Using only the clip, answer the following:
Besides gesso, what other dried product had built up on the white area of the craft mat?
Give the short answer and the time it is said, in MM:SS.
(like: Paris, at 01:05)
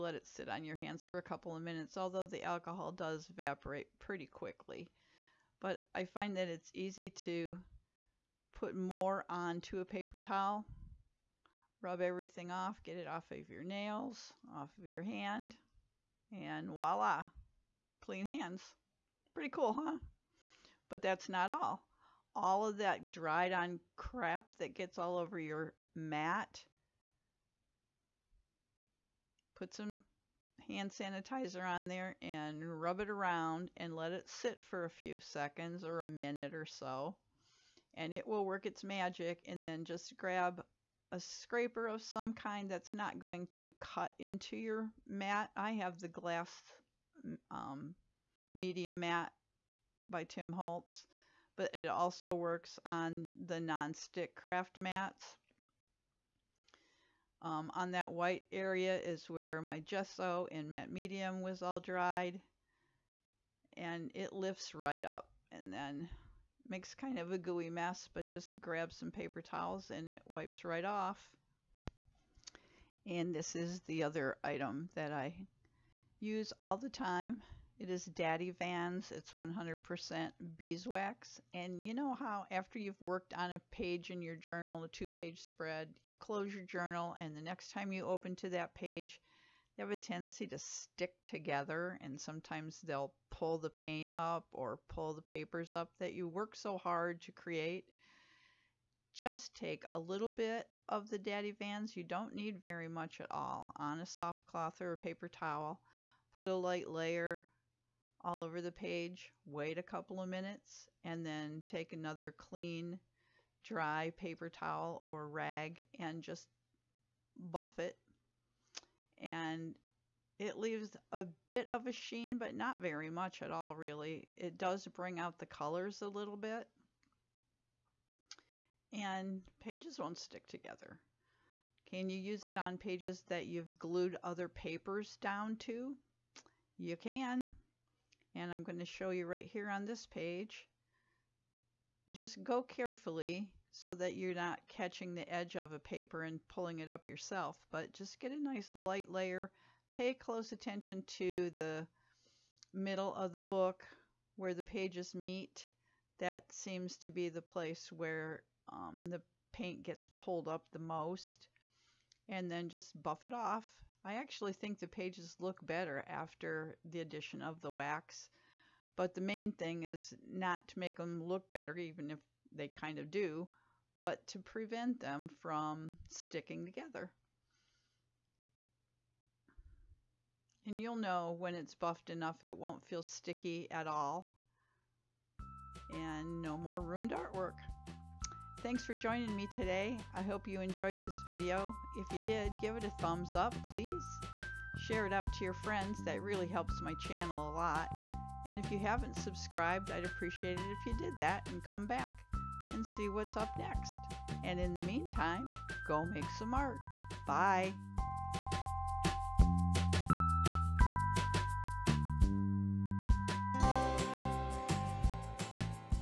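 Matte medium, at 01:00.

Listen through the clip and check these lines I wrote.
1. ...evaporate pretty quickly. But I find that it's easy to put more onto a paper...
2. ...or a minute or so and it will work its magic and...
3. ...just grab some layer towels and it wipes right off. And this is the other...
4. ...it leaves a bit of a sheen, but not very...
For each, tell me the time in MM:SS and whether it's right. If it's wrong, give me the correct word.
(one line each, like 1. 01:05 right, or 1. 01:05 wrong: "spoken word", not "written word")
1. 00:03 right
2. 00:35 right
3. 01:08 wrong: "paper", not "layer"
4. 02:00 right.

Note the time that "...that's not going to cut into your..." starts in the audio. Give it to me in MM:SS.
00:42.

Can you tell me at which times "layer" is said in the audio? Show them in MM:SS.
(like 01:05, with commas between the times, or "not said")
01:46, 02:29.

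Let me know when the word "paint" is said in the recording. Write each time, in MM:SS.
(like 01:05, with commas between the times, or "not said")
01:33, 02:39.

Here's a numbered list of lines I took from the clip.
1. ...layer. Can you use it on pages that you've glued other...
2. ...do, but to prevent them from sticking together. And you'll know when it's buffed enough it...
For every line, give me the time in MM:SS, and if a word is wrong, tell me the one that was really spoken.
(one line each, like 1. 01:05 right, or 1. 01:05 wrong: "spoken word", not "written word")
1. 02:10 wrong: "together", not "layer"
2. 02:53 right.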